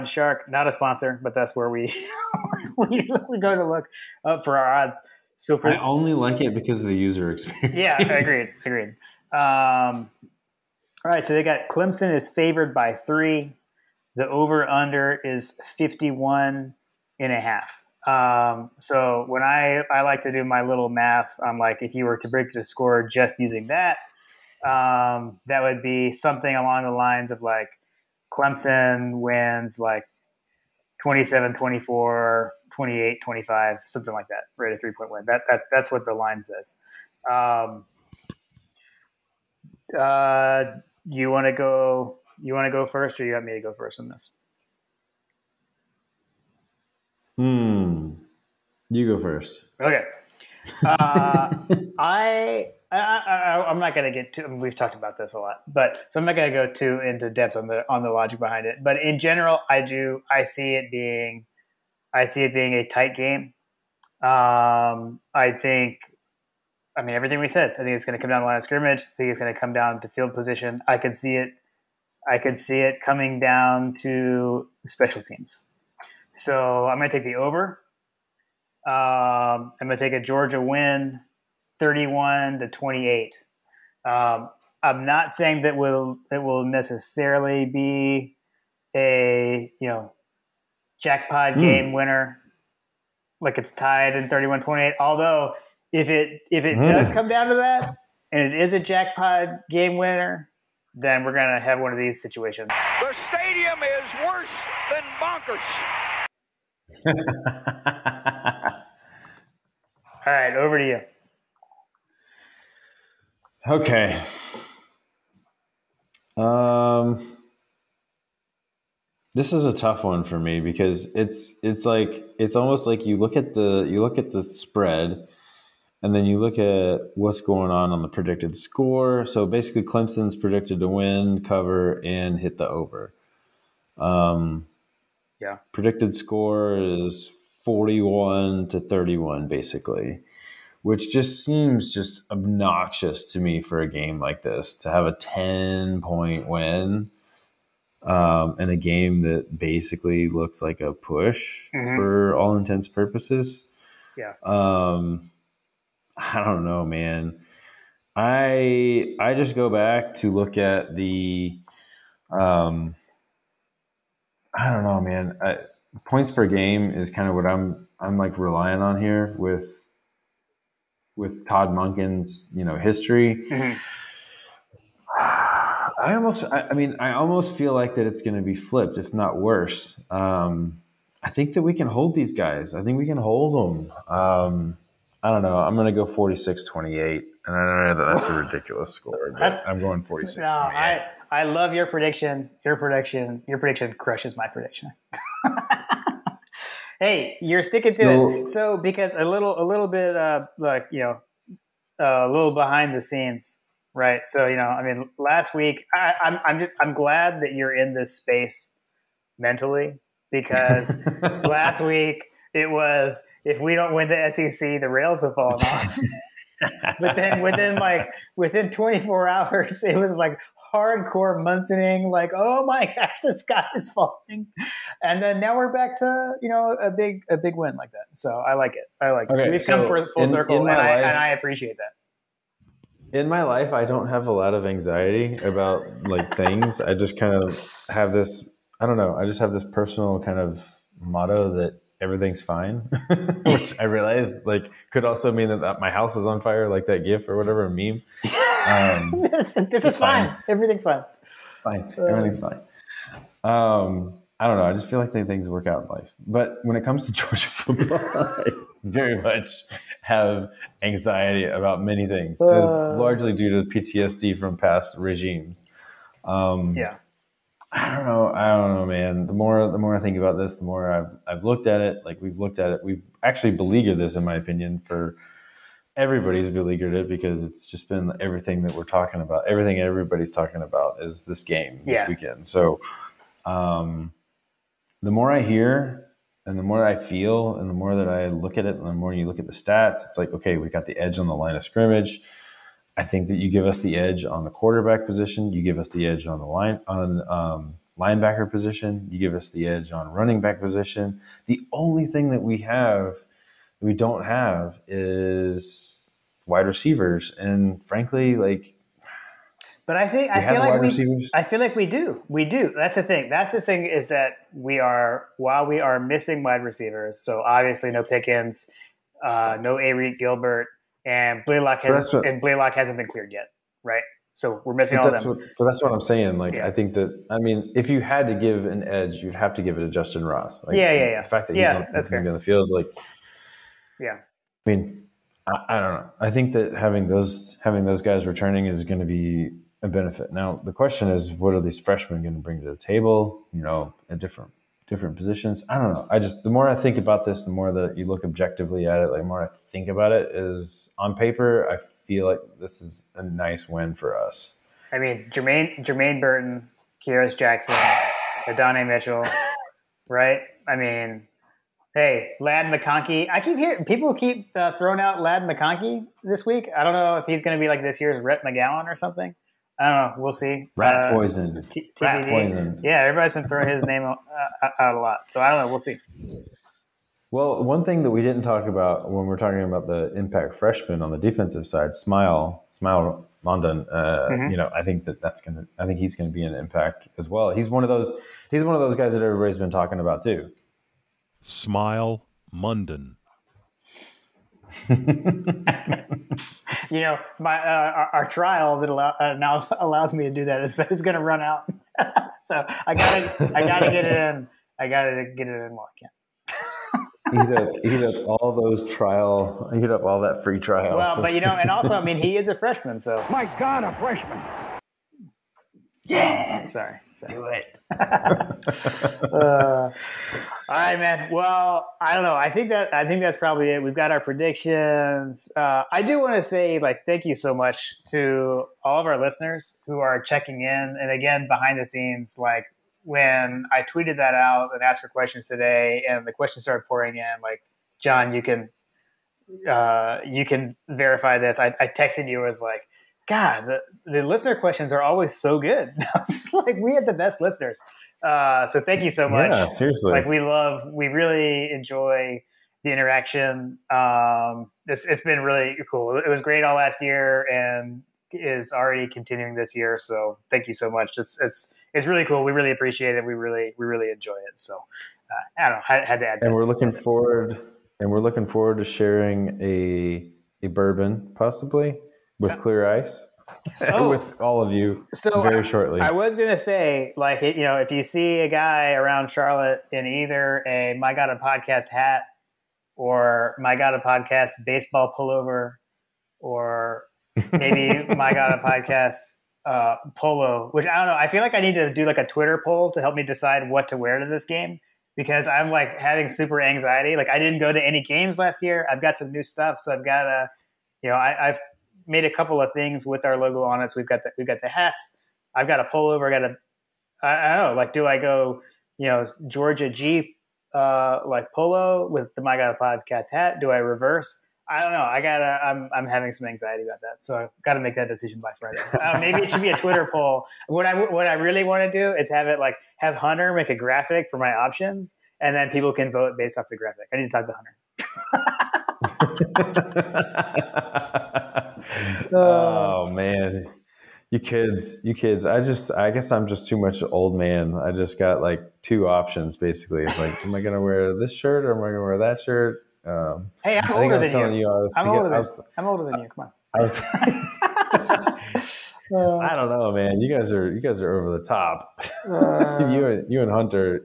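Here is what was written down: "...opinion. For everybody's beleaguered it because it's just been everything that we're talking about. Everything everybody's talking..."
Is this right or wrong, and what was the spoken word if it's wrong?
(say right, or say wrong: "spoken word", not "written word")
right.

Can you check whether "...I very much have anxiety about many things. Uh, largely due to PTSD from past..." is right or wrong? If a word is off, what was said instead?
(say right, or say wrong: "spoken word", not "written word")
right.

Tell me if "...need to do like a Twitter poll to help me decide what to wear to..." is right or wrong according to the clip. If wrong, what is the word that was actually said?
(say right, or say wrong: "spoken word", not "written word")
right.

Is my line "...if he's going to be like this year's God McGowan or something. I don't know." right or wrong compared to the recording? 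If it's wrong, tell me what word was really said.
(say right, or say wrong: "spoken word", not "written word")
wrong: "Rhett", not "God".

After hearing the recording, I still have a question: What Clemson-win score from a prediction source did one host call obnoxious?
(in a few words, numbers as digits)
41 to 31.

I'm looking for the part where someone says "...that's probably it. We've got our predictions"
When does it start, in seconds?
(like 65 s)
423 s.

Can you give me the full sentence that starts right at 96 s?
does come down to that, and it is a jackpot game winner, then we're gonna have one of these situations.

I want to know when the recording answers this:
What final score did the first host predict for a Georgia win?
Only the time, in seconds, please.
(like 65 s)
81 s.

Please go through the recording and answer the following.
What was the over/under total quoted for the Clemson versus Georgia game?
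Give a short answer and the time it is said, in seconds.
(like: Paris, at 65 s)
51.5, at 15 s.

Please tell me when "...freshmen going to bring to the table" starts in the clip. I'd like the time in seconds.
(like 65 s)
341 s.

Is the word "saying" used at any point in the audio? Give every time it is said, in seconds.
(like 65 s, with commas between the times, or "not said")
85 s, 326 s.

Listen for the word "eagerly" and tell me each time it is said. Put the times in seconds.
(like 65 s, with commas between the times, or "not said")
not said.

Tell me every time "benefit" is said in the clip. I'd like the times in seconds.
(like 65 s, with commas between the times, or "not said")
339 s.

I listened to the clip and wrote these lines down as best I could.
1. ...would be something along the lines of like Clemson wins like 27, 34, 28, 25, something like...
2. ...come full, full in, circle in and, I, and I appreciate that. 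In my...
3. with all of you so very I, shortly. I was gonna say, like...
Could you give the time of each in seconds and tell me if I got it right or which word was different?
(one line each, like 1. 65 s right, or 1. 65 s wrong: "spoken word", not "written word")
1. 25 s wrong: "24", not "34"
2. 229 s right
3. 474 s right.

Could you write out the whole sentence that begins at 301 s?
The only thing that we have that we don't have is wide receivers, and frankly, like.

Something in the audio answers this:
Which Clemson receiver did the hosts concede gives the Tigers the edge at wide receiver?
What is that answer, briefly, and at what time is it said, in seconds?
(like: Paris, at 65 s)
Justin Ross, at 329 s.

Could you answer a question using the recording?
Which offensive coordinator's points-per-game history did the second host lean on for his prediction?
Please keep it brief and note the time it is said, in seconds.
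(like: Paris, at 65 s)
Todd Monken, at 171 s.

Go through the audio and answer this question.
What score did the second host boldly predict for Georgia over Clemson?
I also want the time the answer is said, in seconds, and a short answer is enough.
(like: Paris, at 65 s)
46-28, at 186 s.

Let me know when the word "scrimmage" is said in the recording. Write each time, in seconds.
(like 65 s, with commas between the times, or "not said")
68 s, 291 s.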